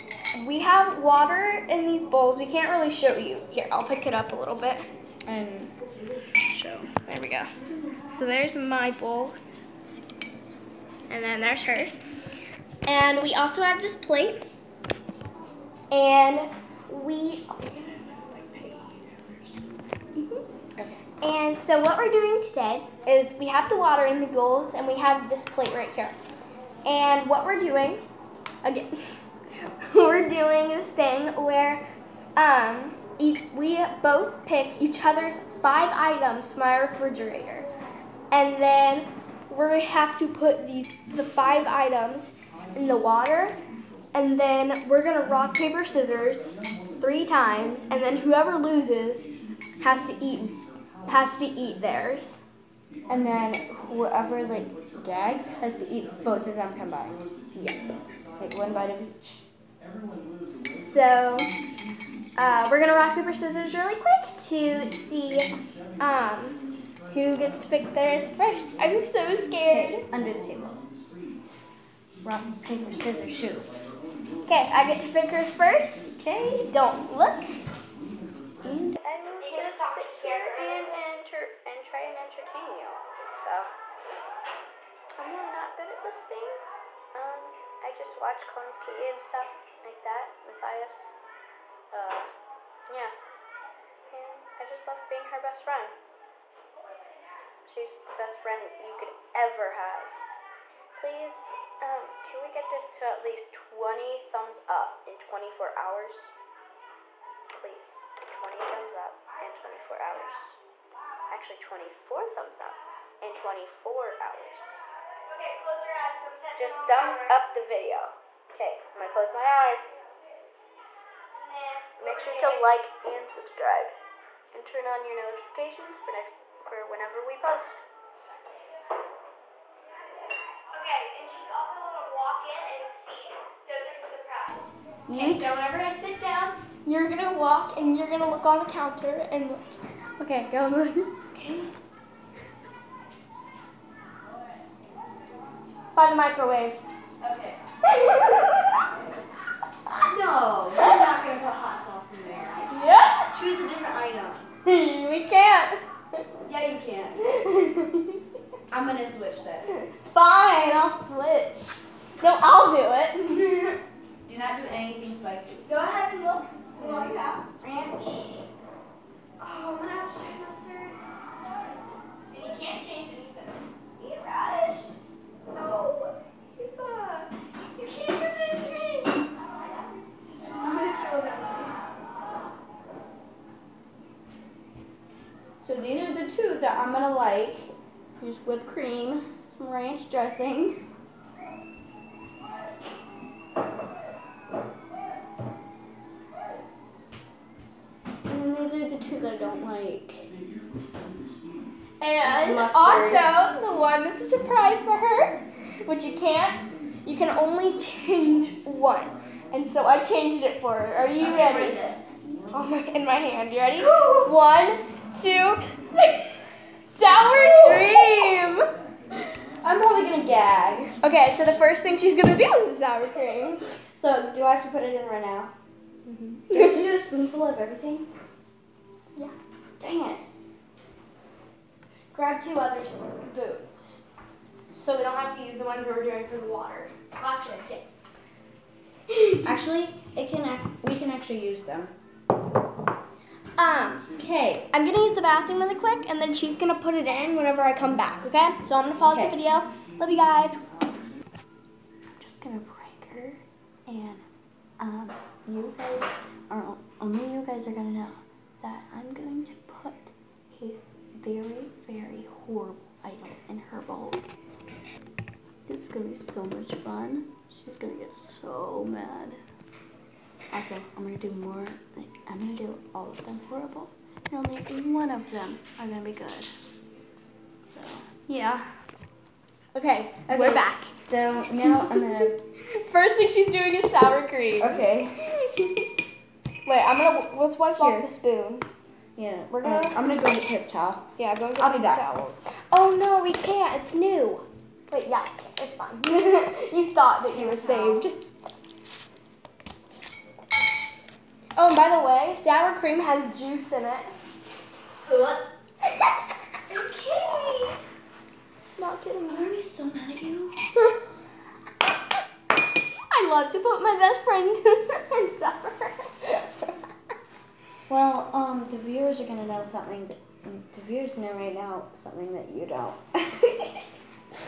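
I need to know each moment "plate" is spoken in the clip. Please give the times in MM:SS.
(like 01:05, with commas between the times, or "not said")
00:13, 00:25.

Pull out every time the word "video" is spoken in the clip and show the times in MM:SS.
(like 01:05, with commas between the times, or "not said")
01:57, 04:09.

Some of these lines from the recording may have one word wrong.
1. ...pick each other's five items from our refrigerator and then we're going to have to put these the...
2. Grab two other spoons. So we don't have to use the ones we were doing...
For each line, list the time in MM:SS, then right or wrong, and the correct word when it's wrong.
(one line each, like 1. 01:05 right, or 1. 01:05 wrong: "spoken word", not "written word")
1. 00:34 right
2. 03:52 right.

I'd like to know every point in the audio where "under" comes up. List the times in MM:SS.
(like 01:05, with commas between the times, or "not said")
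01:10.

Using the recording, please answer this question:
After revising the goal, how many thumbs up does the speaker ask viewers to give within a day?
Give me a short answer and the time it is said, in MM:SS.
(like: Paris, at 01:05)
24, at 01:51.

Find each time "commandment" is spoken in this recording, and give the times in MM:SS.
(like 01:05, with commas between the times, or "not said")
not said.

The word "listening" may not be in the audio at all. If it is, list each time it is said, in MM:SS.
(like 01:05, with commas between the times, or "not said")
not said.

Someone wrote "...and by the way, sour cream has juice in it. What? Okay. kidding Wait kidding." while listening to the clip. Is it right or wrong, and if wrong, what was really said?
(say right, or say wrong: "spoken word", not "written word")
wrong: "Not", not "Wait".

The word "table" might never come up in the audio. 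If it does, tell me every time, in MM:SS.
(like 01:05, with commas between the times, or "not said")
01:10.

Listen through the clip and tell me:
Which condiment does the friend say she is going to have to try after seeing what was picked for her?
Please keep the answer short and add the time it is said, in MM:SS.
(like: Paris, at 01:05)
Mustard, at 02:50.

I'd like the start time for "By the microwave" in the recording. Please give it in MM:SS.
02:25.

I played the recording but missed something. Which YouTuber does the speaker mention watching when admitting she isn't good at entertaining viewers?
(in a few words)
Collins Key.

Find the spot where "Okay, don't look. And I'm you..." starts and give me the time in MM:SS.
01:16.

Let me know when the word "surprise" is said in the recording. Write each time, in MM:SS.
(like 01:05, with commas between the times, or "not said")
02:14, 03:24.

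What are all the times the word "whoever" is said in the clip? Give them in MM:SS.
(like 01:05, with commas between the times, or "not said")
00:48, 00:53.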